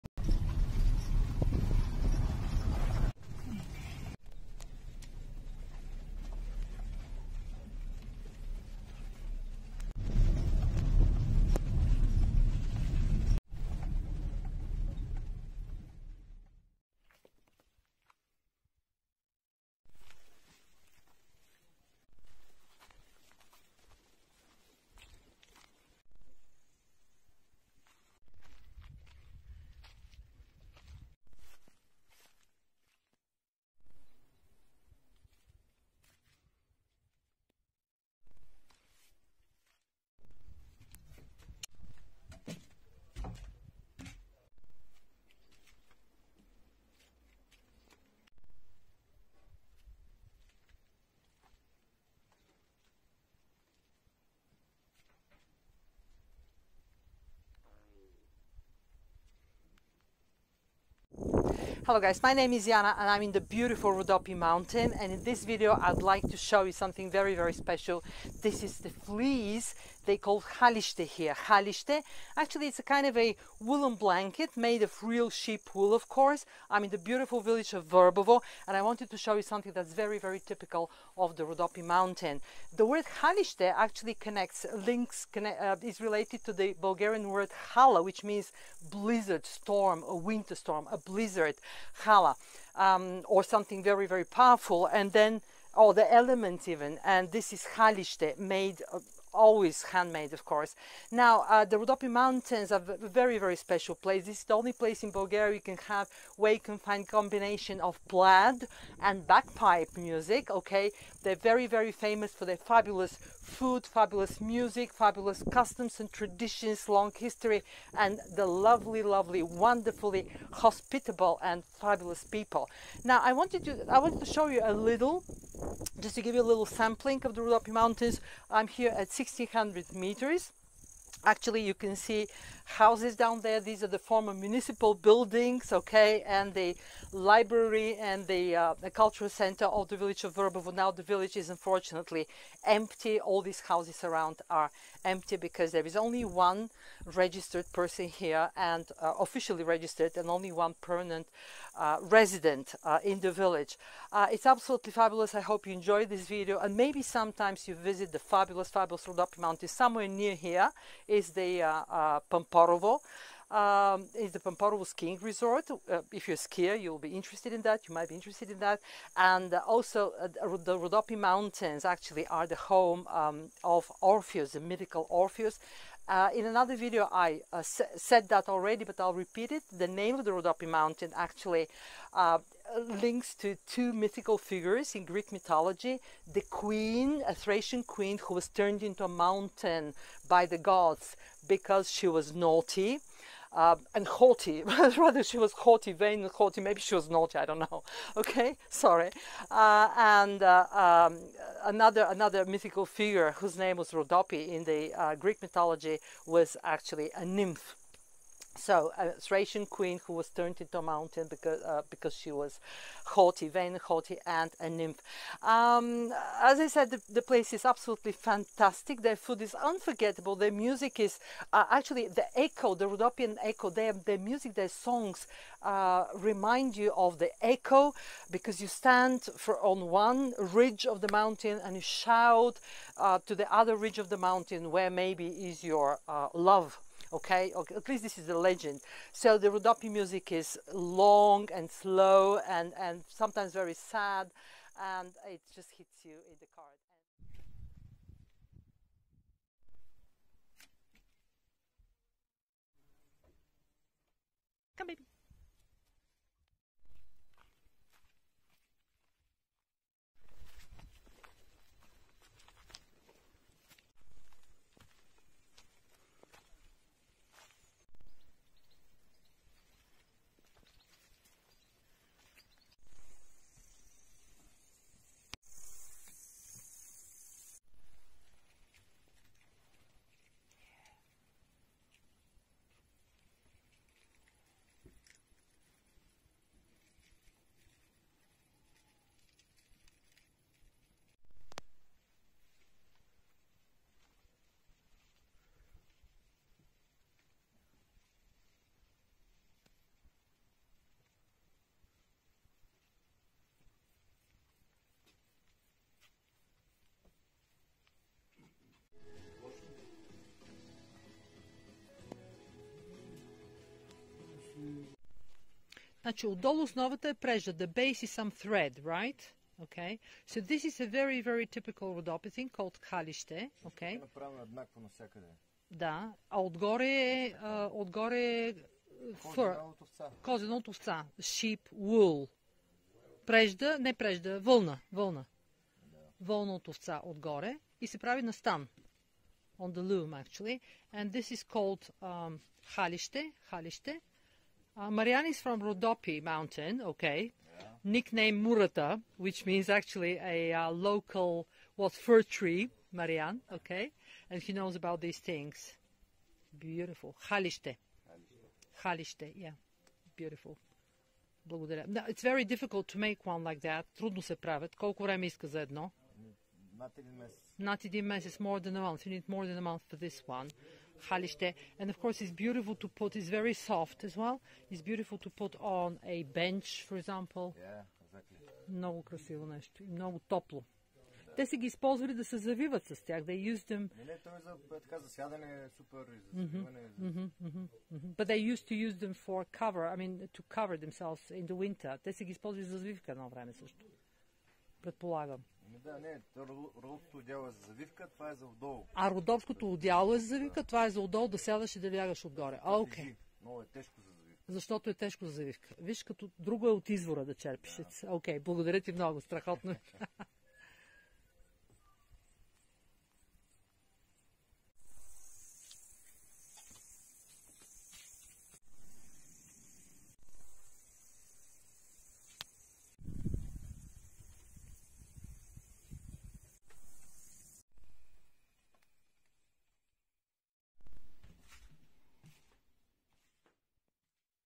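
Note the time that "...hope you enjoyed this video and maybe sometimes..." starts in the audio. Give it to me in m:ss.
2:35.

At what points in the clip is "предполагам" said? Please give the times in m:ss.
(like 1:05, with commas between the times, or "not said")
6:34.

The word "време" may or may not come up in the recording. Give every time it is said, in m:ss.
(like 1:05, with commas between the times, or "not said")
6:05, 6:33.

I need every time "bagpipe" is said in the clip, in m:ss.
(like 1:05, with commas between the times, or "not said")
1:49.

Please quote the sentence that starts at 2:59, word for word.
The name of the Rhodope mountain actually uh, links to two mythical figures in Greek mythology.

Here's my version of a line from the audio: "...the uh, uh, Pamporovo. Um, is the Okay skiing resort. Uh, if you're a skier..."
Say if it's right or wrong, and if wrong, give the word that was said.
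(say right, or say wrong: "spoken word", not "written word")
wrong: "Pamporovo", not "Okay".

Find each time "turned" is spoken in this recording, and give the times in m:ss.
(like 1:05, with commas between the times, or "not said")
3:08, 3:30.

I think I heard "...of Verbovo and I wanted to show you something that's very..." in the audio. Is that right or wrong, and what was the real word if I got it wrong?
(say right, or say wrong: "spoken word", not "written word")
right.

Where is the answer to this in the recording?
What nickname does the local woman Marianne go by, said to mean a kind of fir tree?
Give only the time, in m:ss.
5:48.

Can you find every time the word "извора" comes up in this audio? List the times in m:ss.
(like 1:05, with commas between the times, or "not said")
6:46.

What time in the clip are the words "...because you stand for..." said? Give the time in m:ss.
3:48.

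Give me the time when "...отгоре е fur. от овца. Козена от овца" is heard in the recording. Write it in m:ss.
5:27.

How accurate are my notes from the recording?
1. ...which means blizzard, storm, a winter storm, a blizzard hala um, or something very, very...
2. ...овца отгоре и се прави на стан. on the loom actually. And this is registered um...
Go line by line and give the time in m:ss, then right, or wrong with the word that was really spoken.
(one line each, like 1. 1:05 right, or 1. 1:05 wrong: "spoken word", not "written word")
1. 1:28 right
2. 5:36 wrong: "called", not "registered".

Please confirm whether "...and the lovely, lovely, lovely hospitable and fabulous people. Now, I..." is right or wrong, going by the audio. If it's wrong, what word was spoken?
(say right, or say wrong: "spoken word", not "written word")
wrong: "wonderfully", not "lovely".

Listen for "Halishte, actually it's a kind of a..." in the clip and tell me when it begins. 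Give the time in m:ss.
1:11.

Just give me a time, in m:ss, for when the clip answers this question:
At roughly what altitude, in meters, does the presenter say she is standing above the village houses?
2:09.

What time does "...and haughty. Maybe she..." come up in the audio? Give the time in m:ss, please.
3:16.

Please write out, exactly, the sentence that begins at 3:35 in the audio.
Um, as I said, the, the, place is absolutely fantastic.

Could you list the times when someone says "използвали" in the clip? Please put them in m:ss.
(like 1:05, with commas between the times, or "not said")
6:21, 6:32.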